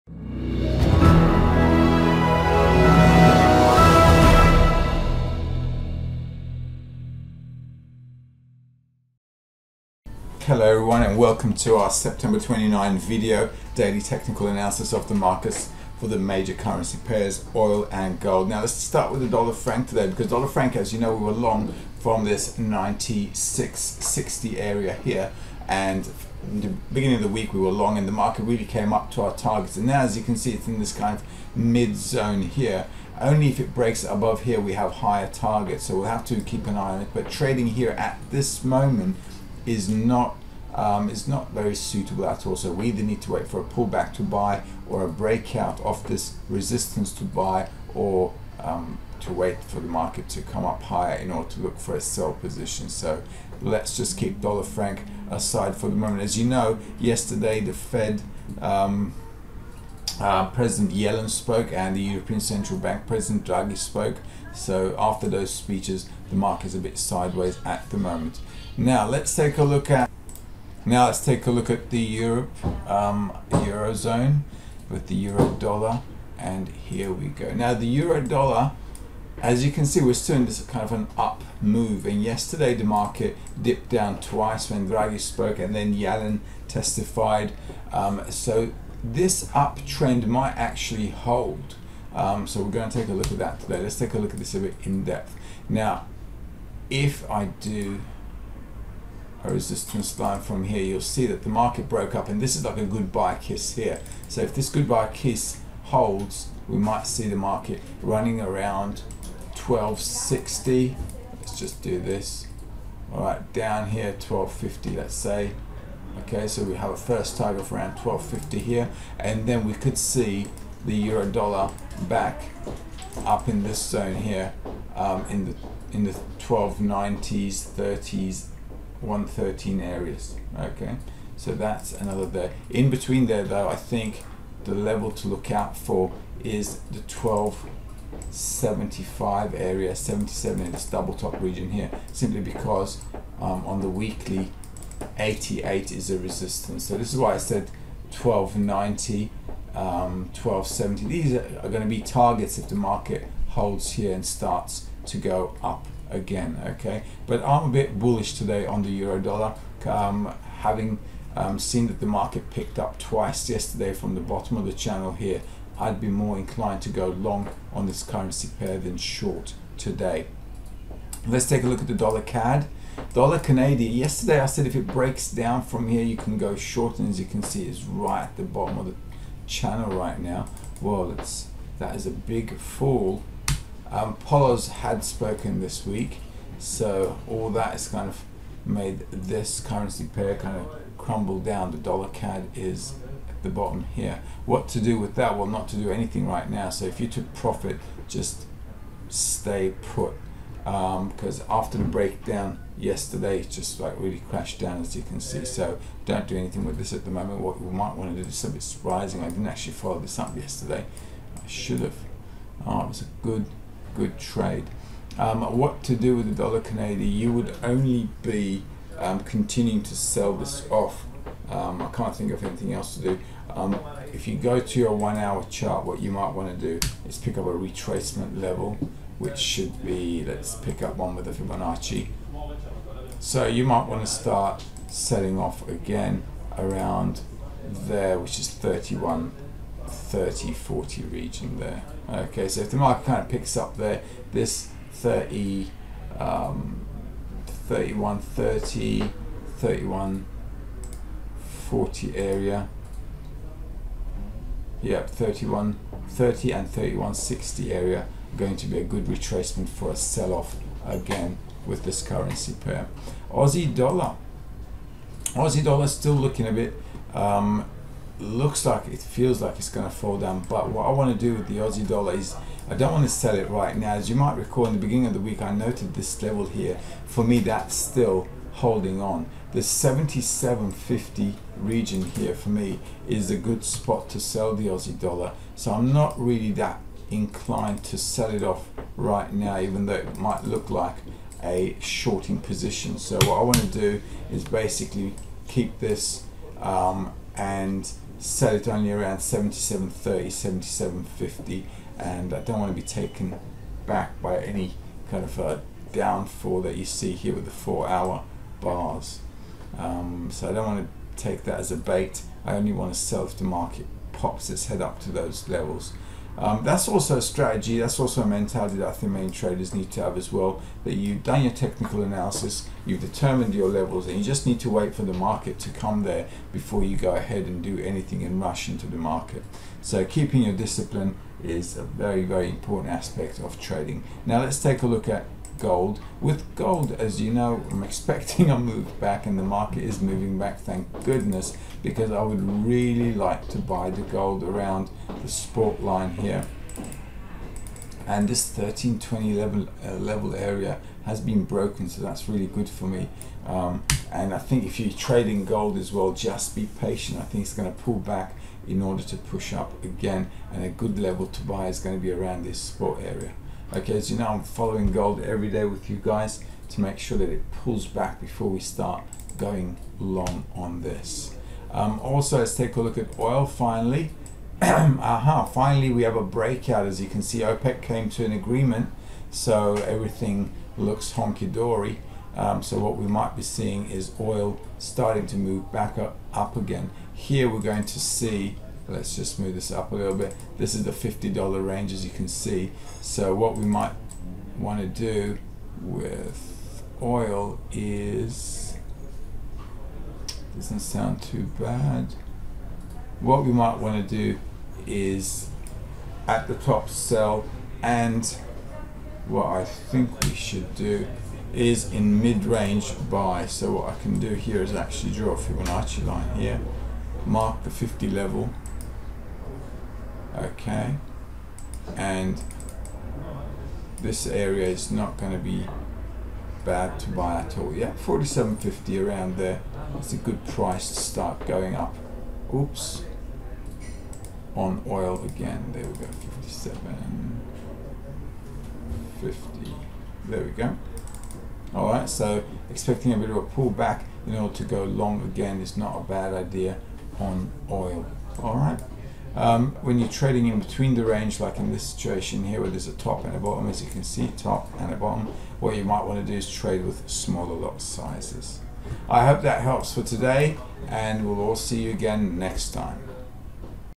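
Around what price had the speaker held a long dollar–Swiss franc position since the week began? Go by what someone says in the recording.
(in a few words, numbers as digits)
96.60.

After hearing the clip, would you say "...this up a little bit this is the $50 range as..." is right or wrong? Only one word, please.
right.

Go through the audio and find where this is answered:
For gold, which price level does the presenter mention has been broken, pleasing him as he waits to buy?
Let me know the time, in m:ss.
5:48.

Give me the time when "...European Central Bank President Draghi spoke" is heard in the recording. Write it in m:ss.
1:02.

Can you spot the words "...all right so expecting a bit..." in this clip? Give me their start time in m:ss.
7:21.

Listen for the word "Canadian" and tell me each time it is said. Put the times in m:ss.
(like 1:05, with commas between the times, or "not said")
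2:53, 3:36.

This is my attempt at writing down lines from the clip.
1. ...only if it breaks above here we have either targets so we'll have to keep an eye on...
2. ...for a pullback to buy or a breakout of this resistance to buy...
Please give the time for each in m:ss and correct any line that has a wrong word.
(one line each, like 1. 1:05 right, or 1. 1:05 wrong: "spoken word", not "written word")
1. 0:33 wrong: "higher", not "either"
2. 0:43 right.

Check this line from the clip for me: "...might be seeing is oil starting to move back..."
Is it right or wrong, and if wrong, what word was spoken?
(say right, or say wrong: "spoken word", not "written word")
right.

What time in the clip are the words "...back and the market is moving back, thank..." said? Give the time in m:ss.
5:38.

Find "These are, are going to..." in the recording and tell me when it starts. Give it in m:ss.
2:31.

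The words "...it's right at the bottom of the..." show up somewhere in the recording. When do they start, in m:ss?
2:57.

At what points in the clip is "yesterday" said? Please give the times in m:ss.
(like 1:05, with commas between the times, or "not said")
0:56, 1:22, 2:43, 2:53, 3:22, 3:30.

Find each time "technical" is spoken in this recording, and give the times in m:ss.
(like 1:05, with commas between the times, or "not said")
0:14, 5:21.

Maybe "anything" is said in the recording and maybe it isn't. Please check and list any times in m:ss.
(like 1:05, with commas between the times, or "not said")
3:15, 3:26, 3:42, 5:27.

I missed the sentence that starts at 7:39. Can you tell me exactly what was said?
I hope that helps for today and we'll all see you again next time.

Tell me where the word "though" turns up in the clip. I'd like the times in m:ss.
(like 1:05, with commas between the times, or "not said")
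2:13, 4:49.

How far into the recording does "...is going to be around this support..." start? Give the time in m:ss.
6:01.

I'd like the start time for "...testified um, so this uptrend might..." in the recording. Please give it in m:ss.
1:26.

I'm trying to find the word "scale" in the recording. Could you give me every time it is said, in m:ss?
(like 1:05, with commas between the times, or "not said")
not said.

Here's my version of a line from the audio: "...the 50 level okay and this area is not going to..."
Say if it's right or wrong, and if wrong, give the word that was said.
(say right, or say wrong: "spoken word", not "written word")
right.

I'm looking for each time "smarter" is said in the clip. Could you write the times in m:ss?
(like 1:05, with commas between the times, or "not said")
not said.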